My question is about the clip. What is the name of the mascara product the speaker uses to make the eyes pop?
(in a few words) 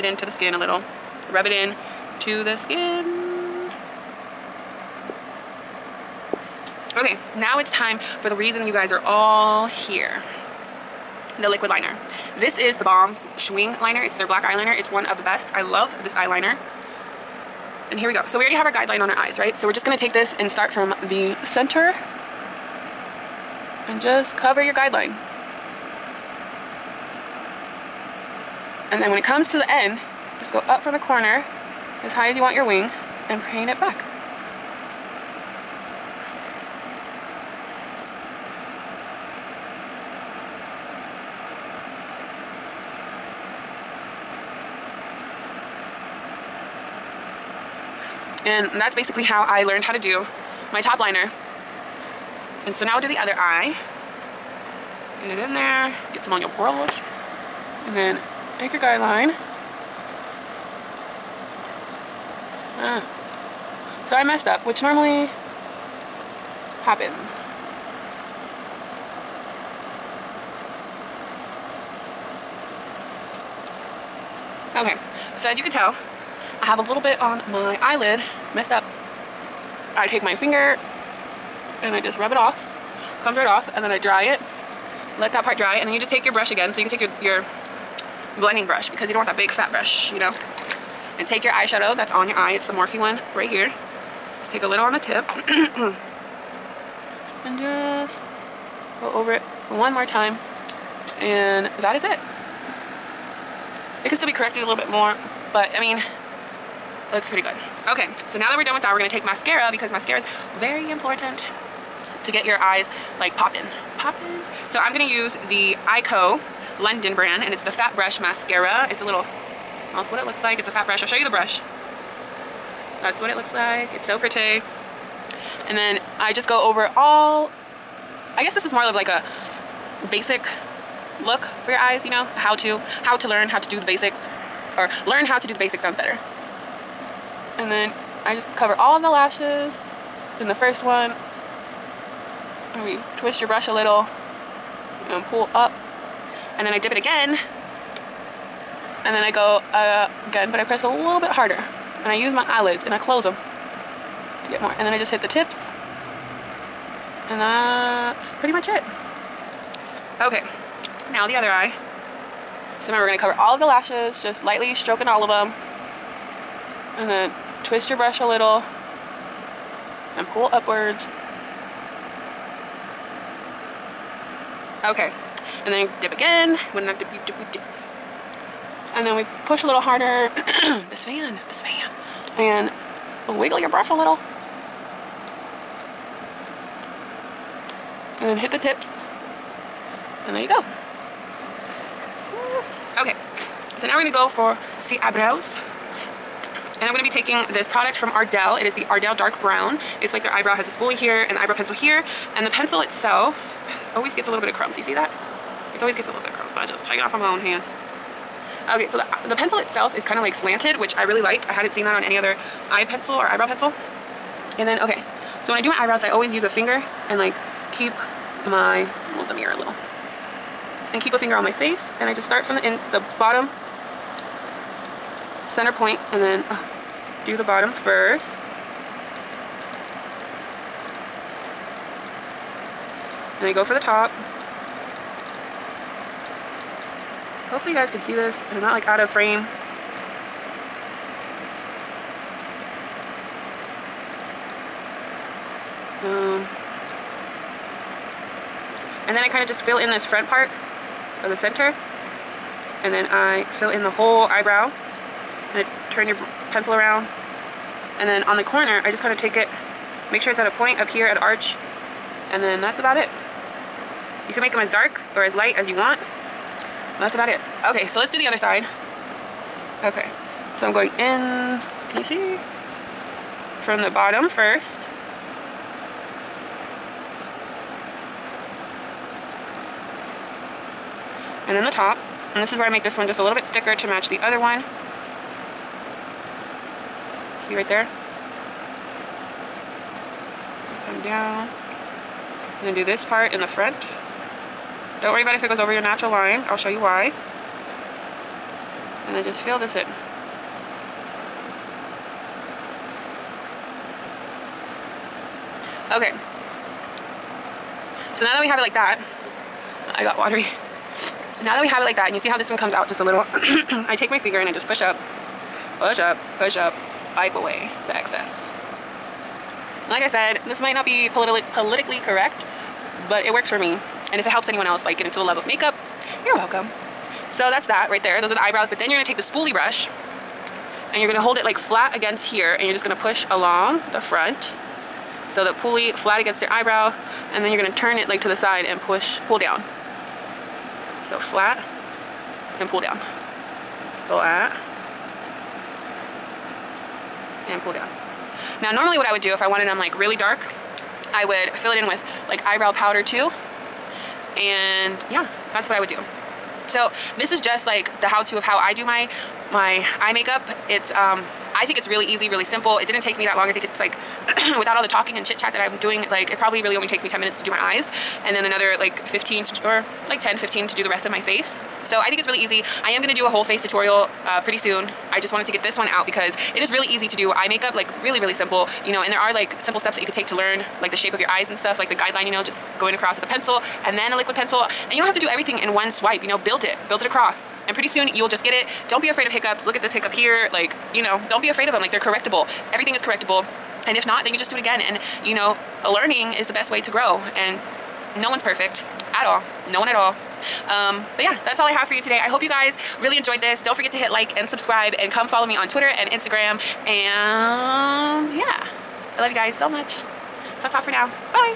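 Fat Brush Mascara.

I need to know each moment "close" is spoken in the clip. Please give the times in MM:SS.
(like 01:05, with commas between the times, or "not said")
02:32.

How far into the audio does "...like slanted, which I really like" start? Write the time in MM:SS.
03:30.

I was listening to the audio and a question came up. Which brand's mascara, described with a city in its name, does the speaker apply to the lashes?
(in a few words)
Eyeko London.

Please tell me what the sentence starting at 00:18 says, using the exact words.
So we already have our guideline on our eyes, right?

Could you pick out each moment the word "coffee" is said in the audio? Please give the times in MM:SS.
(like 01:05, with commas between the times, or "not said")
not said.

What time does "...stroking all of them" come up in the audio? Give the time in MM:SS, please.
02:44.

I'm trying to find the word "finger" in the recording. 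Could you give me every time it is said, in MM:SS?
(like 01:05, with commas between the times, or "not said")
01:20, 03:36, 03:41, 05:14.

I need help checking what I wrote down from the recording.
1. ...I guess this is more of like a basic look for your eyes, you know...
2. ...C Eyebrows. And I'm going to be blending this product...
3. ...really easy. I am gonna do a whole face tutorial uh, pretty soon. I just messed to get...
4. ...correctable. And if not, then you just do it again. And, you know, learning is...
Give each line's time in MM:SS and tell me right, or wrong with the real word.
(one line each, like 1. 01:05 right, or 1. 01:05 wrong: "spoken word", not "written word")
1. 02:08 right
2. 03:14 wrong: "taking", not "blending"
3. 06:12 wrong: "wanted", not "messed"
4. 06:33 right.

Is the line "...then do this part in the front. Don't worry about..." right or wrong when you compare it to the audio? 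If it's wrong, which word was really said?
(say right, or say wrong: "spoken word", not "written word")
right.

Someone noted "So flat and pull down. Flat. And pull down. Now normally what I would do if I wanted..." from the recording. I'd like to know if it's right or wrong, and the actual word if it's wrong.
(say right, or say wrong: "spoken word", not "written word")
right.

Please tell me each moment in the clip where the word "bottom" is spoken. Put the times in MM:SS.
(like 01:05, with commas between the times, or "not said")
03:43, 03:47, 04:33.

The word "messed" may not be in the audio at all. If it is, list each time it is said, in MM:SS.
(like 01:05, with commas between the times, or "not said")
01:04, 01:18.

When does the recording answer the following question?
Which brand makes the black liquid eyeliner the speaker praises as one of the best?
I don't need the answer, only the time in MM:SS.
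00:12.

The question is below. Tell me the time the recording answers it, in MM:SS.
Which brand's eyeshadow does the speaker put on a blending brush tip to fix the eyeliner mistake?
01:32.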